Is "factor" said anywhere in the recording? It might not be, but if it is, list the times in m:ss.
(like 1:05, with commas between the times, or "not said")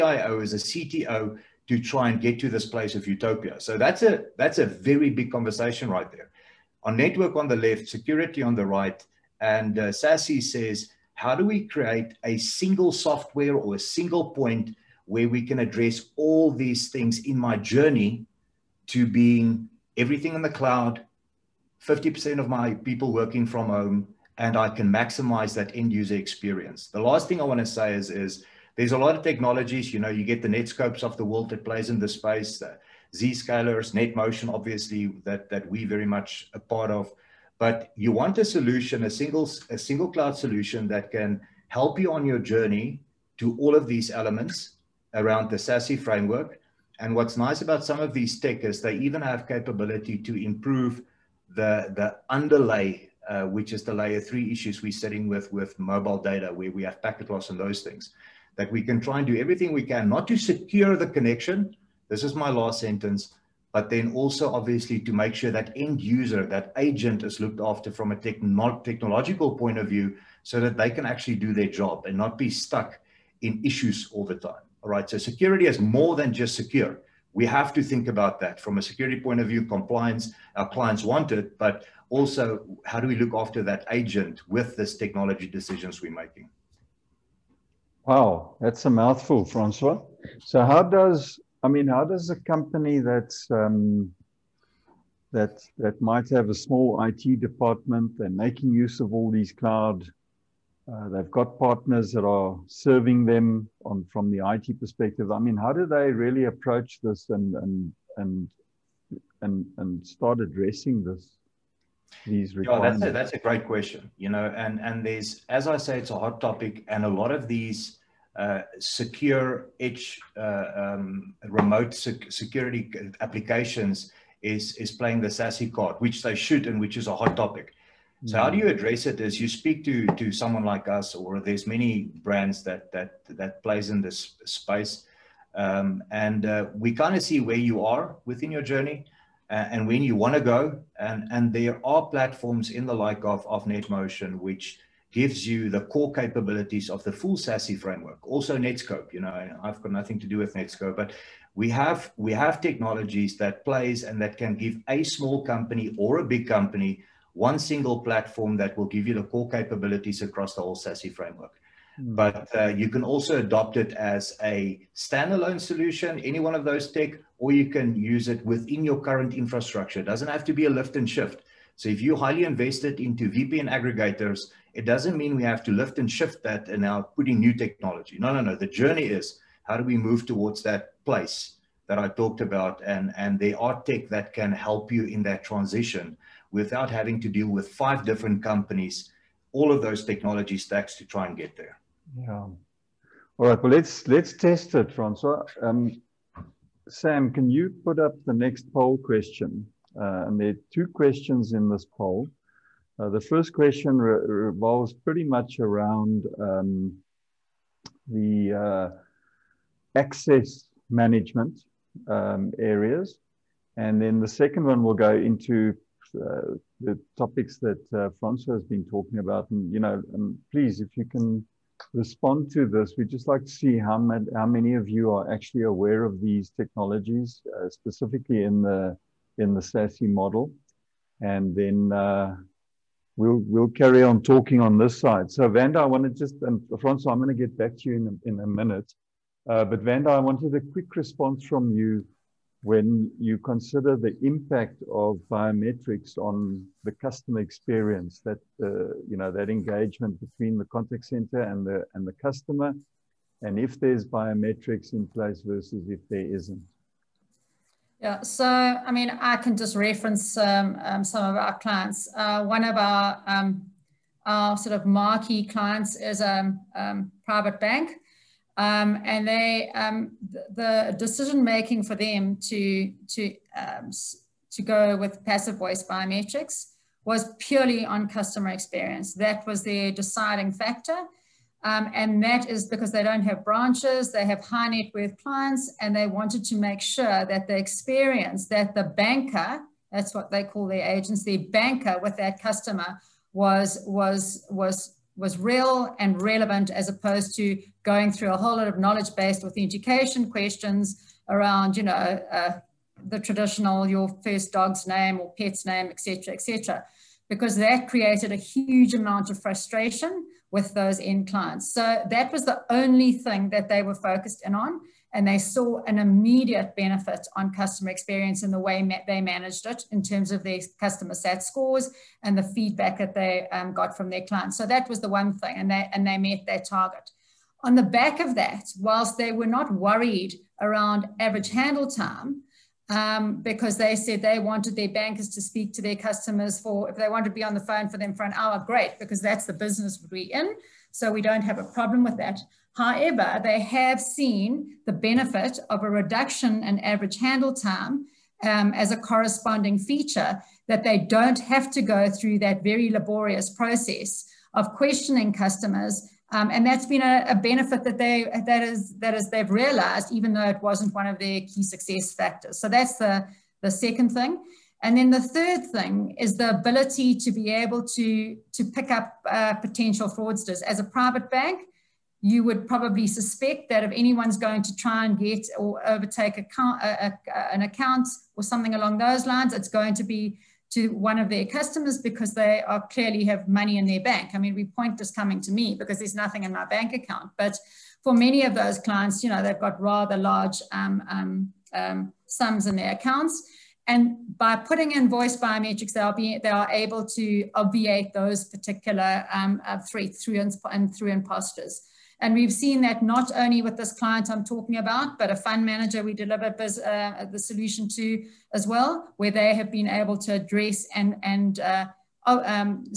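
4:40, 6:02.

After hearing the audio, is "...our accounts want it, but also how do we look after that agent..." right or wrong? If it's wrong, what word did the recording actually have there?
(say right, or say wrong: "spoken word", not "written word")
wrong: "clients", not "accounts".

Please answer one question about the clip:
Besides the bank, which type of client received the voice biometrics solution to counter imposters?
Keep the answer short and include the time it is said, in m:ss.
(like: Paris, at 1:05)
fund manager, at 6:45.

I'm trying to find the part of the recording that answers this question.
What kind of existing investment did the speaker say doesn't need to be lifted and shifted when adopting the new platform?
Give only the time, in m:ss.
2:53.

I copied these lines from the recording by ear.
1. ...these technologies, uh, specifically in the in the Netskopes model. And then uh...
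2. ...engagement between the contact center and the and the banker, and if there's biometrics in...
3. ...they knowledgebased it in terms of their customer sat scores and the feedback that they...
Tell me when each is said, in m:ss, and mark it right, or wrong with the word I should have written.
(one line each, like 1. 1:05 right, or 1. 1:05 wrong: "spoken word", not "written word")
1. 3:46 wrong: "SASE", not "Netskopes"
2. 4:09 wrong: "customer", not "banker"
3. 5:19 wrong: "managed", not "knowledgebased".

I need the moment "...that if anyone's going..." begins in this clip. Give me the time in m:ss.
6:13.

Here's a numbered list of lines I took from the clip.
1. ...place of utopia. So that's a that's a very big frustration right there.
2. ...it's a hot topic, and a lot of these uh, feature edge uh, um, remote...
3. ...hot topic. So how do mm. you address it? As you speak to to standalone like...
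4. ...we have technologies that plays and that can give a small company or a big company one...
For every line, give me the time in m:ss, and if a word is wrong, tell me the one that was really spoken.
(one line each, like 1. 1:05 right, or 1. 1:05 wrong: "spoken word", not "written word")
1. 0:02 wrong: "conversation", not "frustration"
2. 1:55 wrong: "secure", not "feature"
3. 2:07 wrong: "someone", not "standalone"
4. 2:32 right.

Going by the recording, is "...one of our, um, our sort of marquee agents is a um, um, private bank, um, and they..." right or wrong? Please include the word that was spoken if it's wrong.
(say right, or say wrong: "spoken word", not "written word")
wrong: "clients", not "agents".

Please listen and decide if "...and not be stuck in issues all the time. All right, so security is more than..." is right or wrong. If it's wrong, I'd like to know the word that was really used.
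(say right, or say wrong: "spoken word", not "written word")
right.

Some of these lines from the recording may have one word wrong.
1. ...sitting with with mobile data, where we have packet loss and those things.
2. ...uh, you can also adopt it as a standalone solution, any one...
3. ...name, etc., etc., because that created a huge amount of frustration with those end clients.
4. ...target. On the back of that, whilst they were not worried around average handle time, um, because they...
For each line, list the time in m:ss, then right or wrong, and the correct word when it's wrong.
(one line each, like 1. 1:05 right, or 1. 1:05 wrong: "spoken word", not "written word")
1. 0:54 right
2. 2:42 right
3. 5:05 right
4. 5:26 right.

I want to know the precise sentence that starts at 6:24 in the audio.
I mean, we point this coming to me because there's nothing in my bank account.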